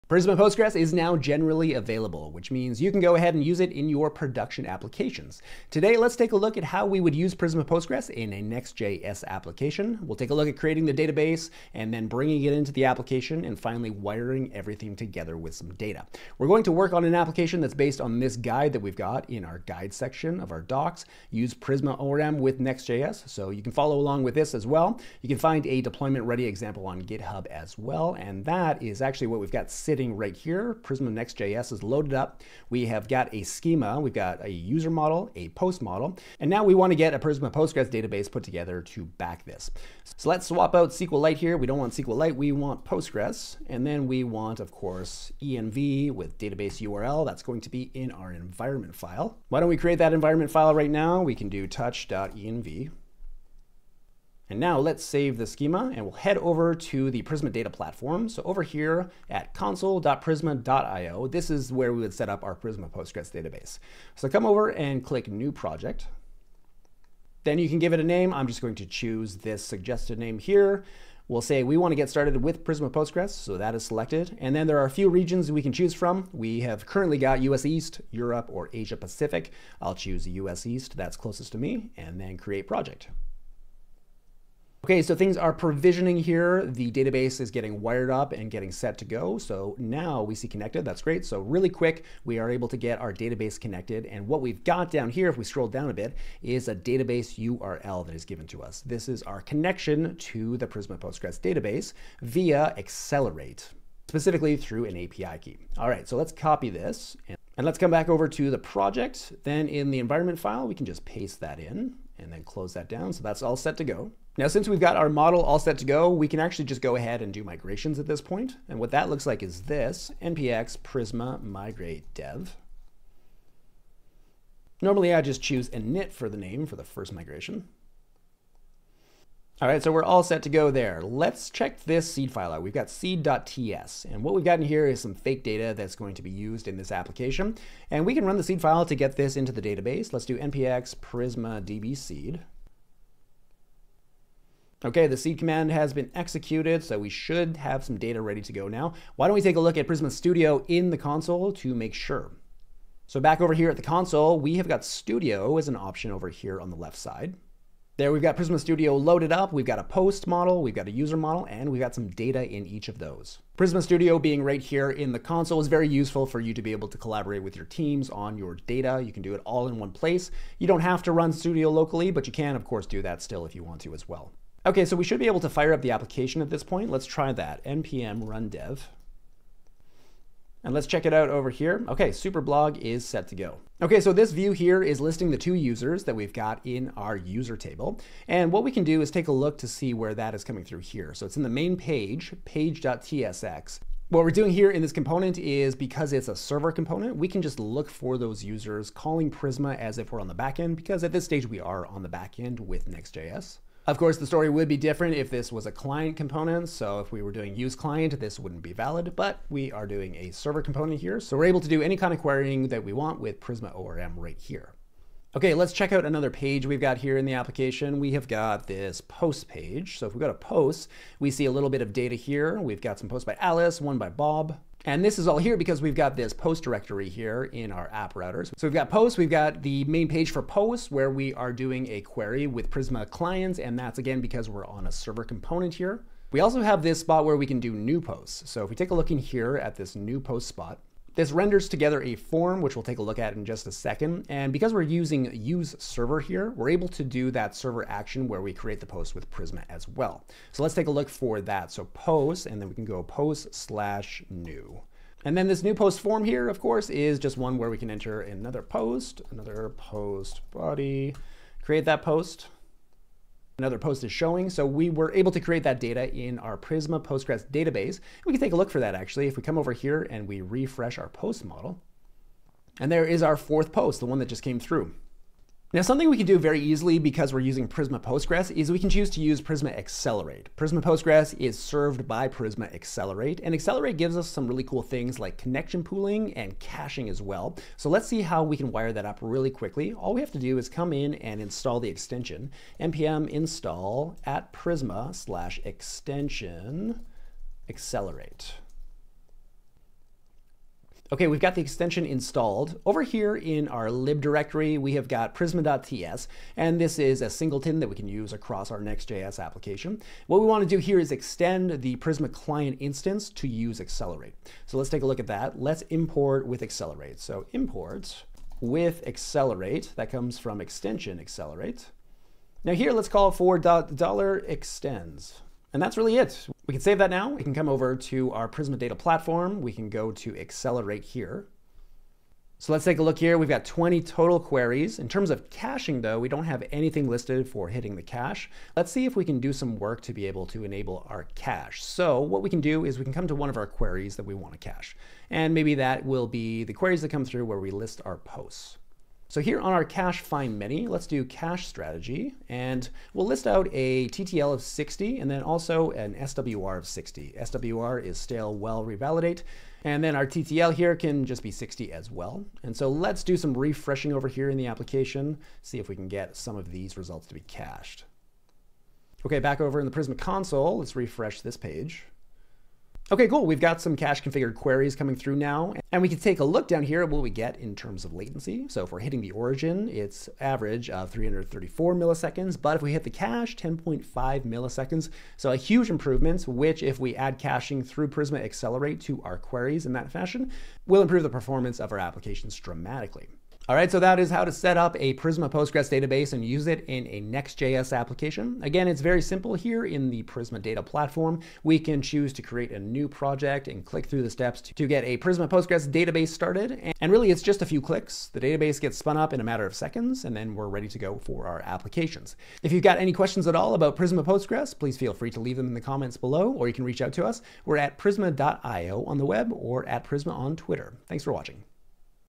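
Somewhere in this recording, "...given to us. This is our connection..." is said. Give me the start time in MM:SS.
01:38.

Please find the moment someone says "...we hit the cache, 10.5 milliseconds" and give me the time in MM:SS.
06:22.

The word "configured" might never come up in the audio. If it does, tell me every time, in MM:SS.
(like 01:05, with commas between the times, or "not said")
06:14.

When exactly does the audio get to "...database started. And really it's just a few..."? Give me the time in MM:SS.
06:45.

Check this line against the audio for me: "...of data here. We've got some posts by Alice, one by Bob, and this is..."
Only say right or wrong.
right.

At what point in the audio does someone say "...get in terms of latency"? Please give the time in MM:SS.
06:17.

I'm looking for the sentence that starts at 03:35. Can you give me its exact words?
Okay, let's check out another page we've got here in the application.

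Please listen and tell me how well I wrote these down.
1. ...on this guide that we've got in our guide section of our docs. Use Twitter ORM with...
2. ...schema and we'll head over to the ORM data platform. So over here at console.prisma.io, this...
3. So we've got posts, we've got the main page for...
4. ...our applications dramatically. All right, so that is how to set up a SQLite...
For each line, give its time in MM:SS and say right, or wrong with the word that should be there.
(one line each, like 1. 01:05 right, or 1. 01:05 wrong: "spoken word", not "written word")
1. 00:18 wrong: "Prisma", not "Twitter"
2. 00:55 wrong: "Prisma", not "ORM"
3. 03:48 right
4. 06:31 wrong: "Prisma", not "SQLite".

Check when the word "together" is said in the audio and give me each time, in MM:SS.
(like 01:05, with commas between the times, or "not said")
00:14, 00:38, 04:01.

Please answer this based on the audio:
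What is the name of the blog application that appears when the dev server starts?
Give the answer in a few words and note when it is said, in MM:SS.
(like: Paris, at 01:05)
Superblog, at 03:02.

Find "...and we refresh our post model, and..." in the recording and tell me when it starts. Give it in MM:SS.
04:30.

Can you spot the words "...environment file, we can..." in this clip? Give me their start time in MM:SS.
01:49.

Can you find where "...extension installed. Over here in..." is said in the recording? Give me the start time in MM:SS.
05:01.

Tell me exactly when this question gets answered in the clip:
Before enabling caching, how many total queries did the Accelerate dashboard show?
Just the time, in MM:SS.
05:33.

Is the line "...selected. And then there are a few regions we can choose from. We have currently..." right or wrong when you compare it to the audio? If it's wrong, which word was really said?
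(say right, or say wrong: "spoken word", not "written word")
right.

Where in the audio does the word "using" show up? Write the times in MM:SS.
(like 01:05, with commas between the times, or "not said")
04:04, 04:37.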